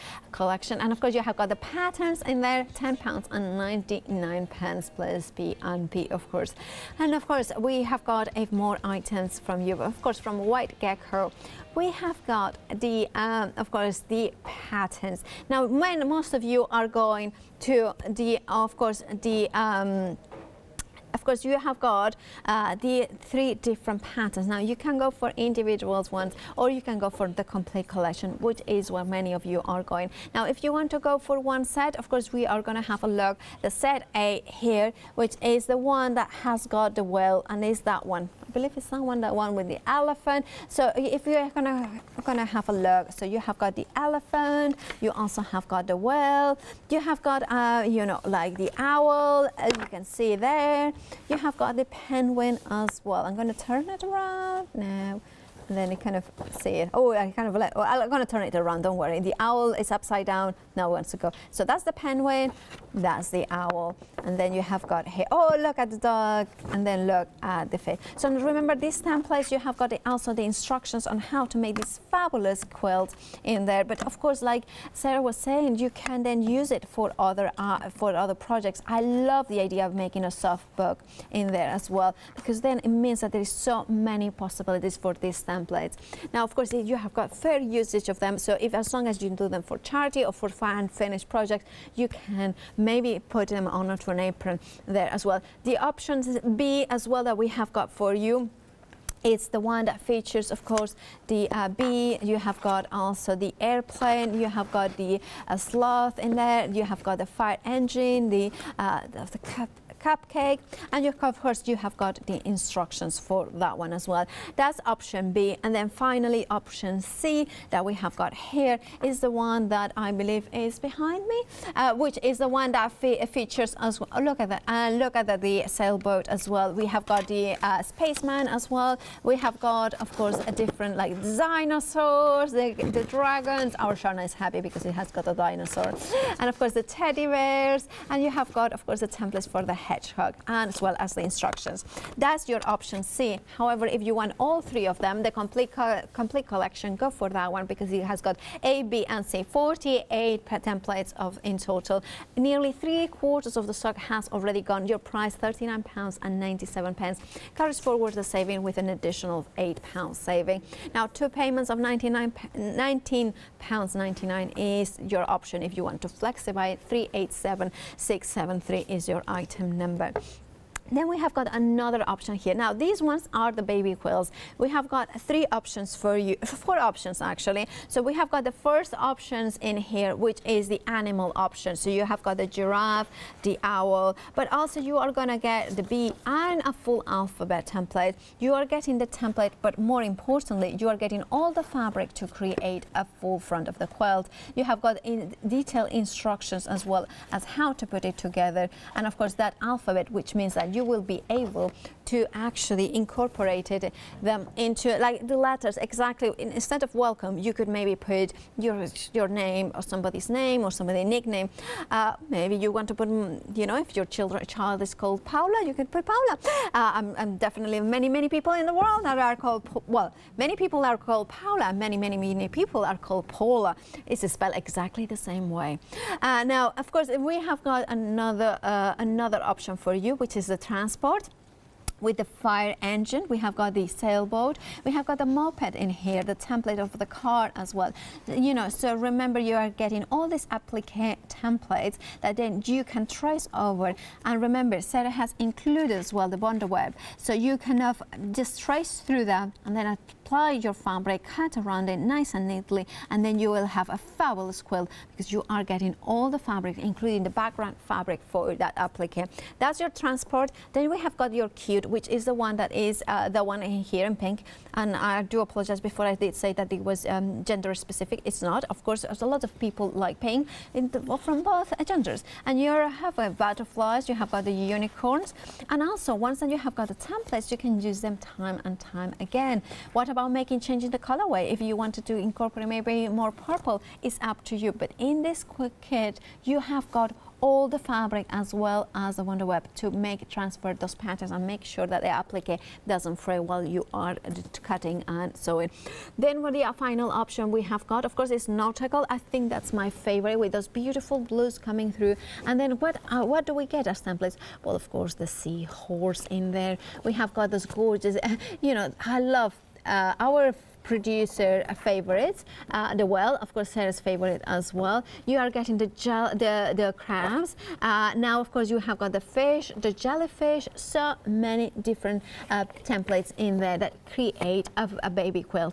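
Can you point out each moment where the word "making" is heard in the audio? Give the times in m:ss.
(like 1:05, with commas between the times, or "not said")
1:19, 4:40.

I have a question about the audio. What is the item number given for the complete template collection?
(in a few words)
387673.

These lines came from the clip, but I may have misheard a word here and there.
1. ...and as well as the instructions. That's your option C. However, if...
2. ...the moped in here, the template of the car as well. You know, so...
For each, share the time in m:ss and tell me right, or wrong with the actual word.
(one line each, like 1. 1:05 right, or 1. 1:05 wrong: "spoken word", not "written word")
1. 2:20 right
2. 3:55 right.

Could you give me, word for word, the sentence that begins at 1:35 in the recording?
The options B as well that we have got for you it's the one that features, of course, the uh, bee.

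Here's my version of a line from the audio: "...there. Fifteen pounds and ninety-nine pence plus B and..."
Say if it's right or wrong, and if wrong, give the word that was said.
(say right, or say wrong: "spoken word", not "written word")
wrong: "Ten", not "Fifteen".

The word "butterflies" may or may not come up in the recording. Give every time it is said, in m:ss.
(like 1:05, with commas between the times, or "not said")
4:33.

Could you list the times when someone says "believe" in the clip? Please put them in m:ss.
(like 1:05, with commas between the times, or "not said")
0:38, 2:00.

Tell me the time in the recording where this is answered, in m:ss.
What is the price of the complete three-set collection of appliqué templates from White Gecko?
2:35.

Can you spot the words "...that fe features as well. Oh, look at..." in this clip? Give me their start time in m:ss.
2:02.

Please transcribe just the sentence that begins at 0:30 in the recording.
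Now, if you want to go for one set, of course, we are going to have a look.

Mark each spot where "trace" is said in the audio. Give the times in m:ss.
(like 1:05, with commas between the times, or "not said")
4:03, 4:08.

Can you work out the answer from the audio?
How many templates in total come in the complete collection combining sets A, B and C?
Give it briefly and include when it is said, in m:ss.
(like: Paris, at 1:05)
48, at 2:29.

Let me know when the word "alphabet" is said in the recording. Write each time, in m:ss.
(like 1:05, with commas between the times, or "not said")
3:07, 3:19.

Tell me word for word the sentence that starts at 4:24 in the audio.
And I do apologize before I did say that it was um, gender specific.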